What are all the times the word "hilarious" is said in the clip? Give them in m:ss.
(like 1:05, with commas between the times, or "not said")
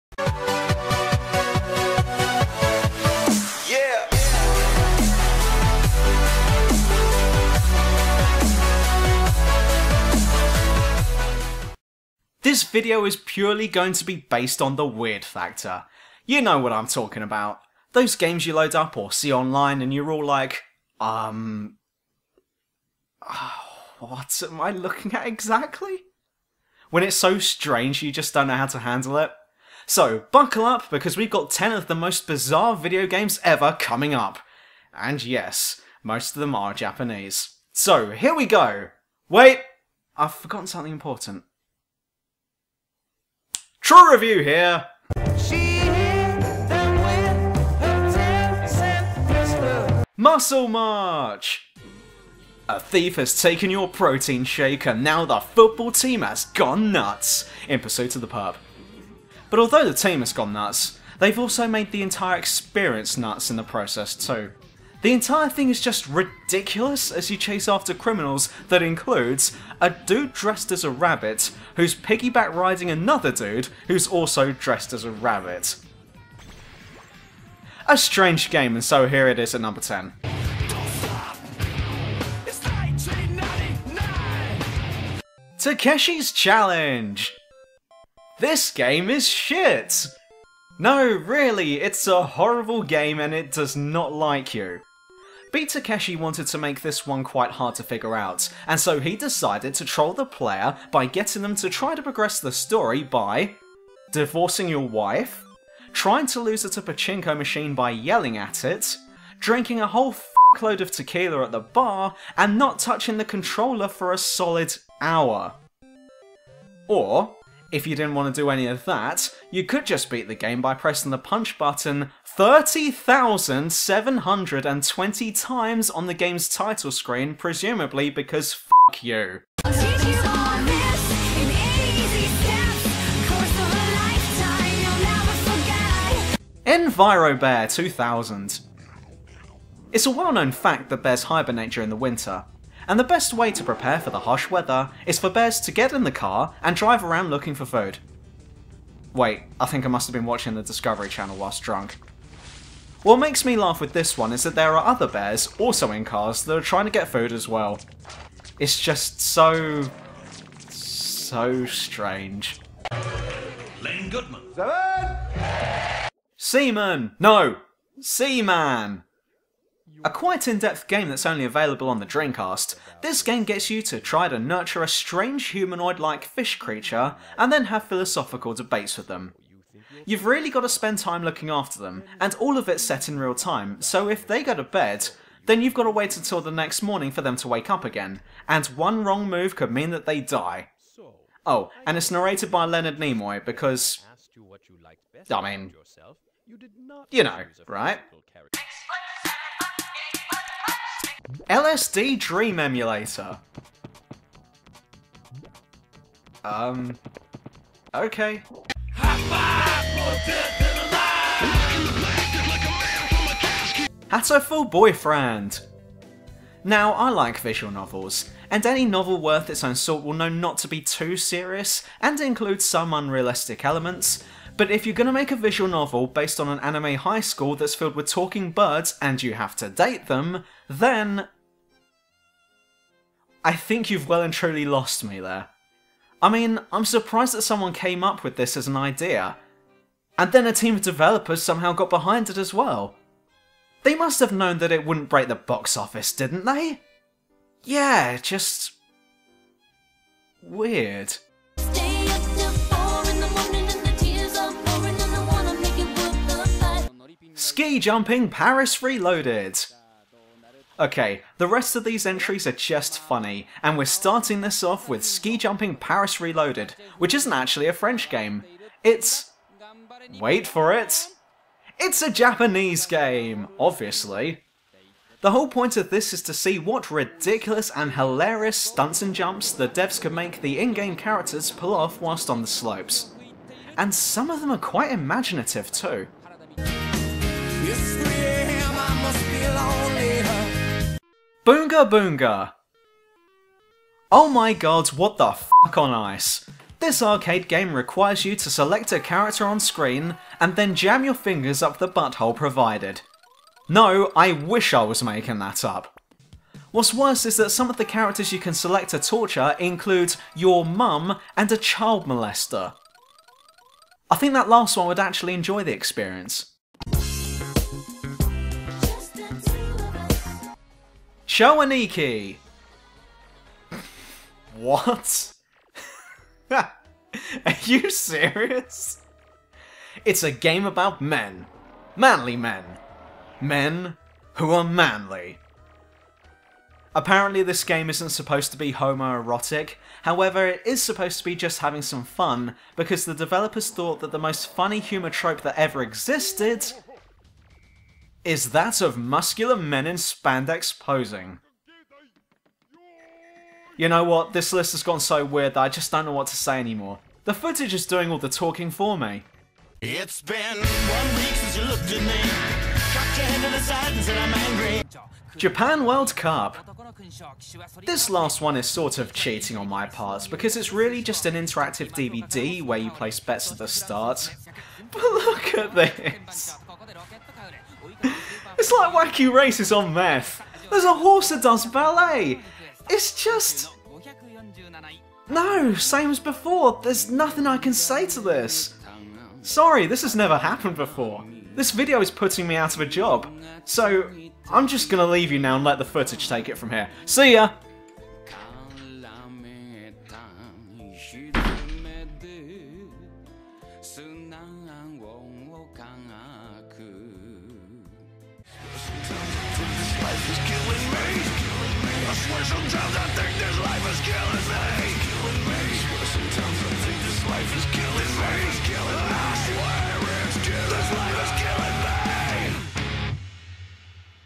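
4:37.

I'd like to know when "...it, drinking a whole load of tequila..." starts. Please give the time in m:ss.
1:48.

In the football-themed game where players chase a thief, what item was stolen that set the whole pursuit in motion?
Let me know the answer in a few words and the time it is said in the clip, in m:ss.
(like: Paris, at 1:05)
protein shake, at 0:53.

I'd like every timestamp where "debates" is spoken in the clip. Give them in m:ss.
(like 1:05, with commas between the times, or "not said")
2:58.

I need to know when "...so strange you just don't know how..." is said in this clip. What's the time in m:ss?
0:27.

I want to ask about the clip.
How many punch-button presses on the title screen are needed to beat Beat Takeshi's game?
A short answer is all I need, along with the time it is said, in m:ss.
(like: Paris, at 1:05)
30,720, at 2:02.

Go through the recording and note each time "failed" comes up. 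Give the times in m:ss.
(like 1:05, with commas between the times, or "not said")
not said.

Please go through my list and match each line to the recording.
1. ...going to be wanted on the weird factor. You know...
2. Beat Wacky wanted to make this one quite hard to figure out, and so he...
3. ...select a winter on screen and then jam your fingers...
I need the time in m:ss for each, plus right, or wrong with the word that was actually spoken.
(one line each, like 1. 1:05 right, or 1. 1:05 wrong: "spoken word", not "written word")
1. 0:13 wrong: "based", not "wanted"
2. 1:35 wrong: "Takeshi", not "Wacky"
3. 4:58 wrong: "character", not "winter".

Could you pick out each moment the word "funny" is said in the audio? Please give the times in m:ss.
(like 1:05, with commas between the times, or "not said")
4:22, 5:44.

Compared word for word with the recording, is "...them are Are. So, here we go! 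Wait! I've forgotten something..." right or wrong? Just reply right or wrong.
wrong.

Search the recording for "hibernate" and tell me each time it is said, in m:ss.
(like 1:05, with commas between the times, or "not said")
2:21.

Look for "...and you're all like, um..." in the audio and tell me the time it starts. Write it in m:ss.
0:19.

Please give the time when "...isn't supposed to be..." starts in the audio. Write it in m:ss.
5:37.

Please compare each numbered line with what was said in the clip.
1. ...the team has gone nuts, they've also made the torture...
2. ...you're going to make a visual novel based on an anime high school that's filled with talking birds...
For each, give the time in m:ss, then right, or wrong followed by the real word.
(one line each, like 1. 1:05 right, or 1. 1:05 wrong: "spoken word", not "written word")
1. 0:59 wrong: "entire", not "torture"
2. 3:44 right.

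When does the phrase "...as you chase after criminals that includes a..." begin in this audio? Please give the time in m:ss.
1:07.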